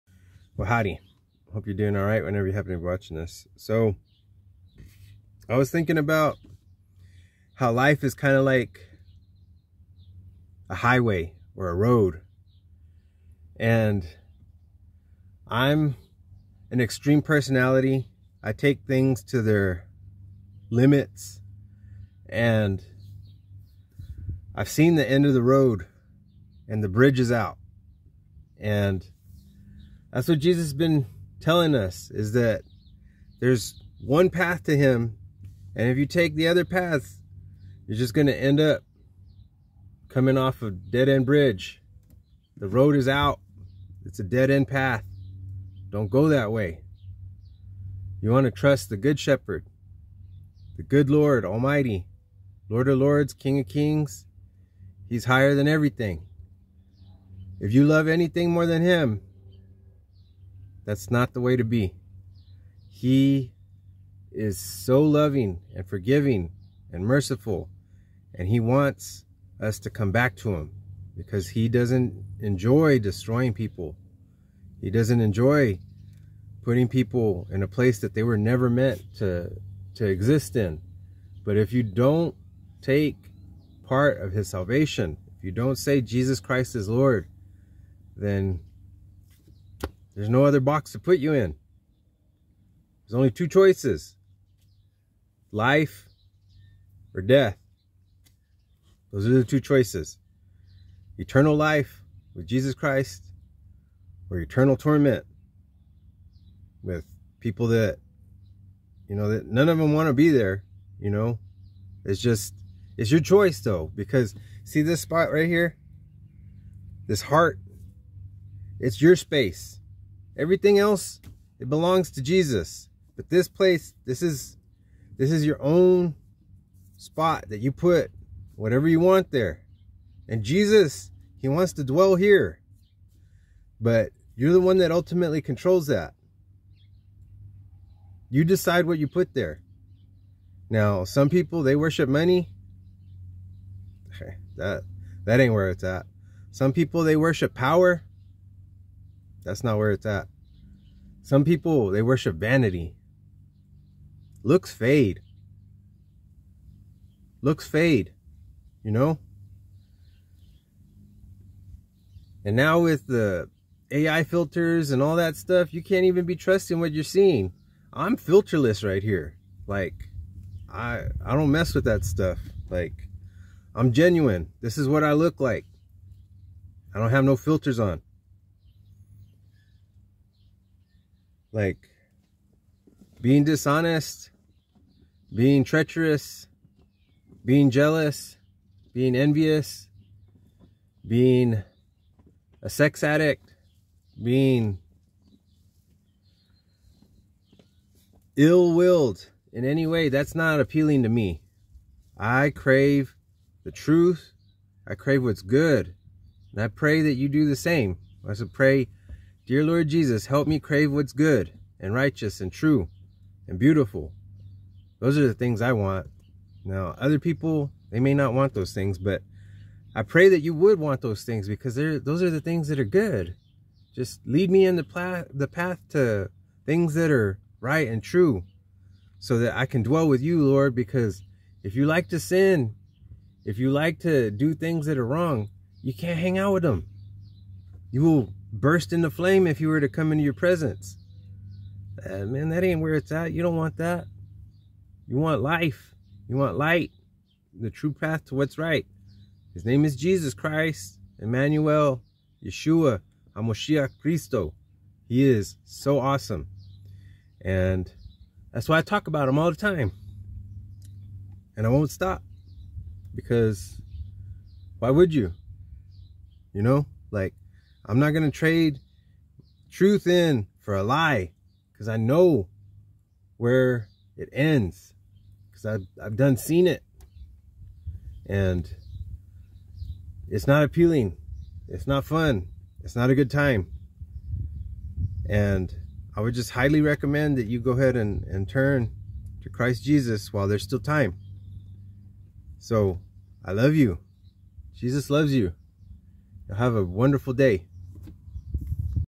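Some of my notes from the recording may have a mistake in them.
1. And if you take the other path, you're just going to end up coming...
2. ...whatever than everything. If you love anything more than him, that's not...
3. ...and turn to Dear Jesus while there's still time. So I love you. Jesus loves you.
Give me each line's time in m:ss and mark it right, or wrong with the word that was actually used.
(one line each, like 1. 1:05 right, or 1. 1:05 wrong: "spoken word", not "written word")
1. 0:35 right
2. 0:55 wrong: "higher", not "whatever"
3. 4:48 wrong: "Christ", not "Dear".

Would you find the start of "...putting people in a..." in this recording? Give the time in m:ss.
1:16.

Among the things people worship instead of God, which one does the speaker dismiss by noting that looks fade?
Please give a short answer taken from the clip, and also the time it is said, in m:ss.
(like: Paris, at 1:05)
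vanity, at 2:32.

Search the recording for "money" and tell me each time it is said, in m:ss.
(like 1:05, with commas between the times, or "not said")
2:22.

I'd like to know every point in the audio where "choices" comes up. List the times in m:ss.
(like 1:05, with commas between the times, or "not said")
1:33, 1:39, 1:53.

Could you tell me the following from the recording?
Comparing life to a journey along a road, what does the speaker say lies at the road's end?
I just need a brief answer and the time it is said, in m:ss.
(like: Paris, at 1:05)
the bridge, at 0:26.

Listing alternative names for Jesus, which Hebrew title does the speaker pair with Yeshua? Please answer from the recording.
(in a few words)
HaMashiach.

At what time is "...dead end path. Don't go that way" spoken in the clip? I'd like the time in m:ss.
0:44.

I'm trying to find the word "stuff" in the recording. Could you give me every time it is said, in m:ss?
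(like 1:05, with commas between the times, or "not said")
2:45, 2:52.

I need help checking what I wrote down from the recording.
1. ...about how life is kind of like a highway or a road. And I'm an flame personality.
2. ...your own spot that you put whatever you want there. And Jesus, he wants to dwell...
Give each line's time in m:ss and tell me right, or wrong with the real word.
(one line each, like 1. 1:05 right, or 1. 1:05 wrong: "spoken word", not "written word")
1. 0:05 wrong: "extreme", not "flame"
2. 2:05 right.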